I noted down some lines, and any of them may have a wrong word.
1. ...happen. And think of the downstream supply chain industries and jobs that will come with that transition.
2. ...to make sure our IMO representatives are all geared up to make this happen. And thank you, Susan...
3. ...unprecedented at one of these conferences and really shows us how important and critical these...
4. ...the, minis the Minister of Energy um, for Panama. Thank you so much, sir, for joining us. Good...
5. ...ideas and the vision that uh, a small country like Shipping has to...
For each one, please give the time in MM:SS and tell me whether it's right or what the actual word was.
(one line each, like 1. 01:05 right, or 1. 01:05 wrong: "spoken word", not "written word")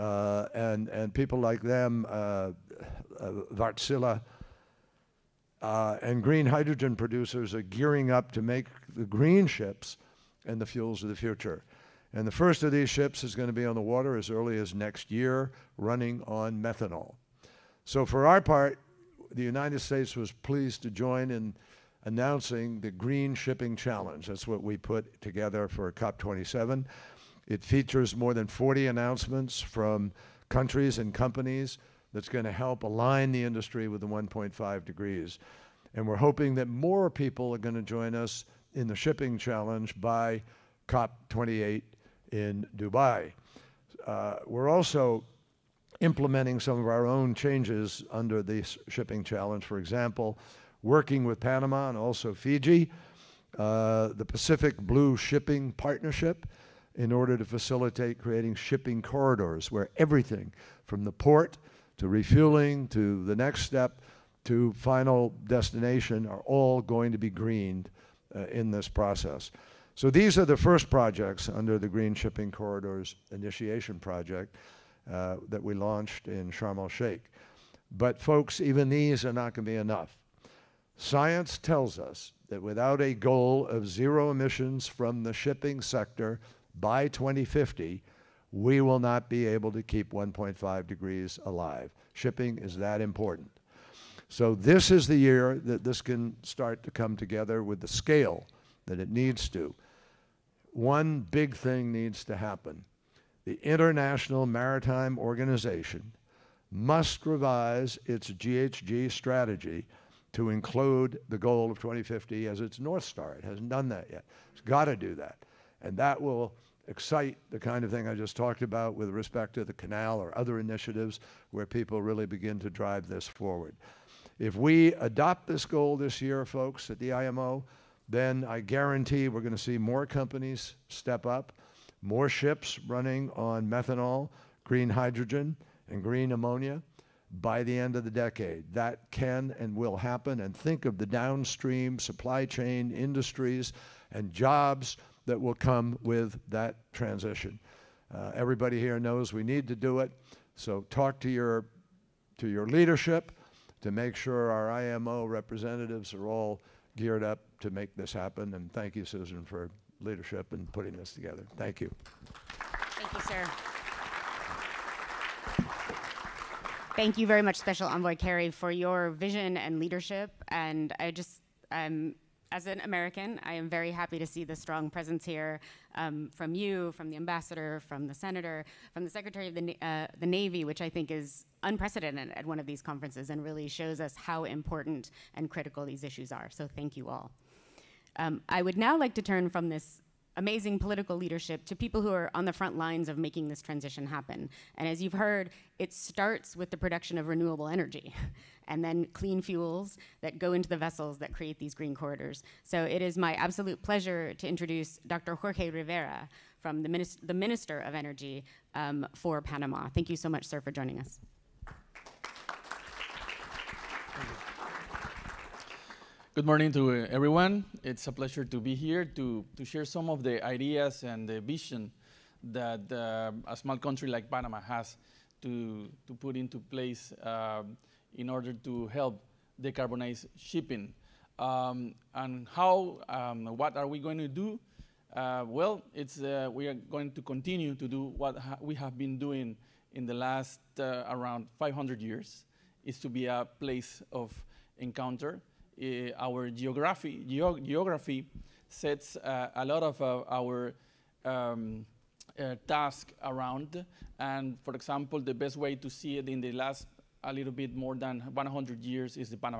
1. 02:19 right
2. 02:33 right
3. 03:01 right
4. 03:26 right
5. 03:40 wrong: "Panama", not "Shipping".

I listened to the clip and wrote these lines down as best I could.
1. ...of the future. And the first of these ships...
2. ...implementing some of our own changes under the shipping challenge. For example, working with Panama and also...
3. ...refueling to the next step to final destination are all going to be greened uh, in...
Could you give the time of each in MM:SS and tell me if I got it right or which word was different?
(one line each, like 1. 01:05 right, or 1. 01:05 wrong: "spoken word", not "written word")
1. 00:11 right
2. 00:46 right
3. 01:02 right.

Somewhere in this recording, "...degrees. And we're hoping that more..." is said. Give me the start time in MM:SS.
00:34.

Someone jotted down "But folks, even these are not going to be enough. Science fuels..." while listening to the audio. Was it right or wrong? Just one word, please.
wrong.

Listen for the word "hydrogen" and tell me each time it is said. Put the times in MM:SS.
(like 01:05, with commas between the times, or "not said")
00:06, 02:14.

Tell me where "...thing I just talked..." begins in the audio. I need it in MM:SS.
01:57.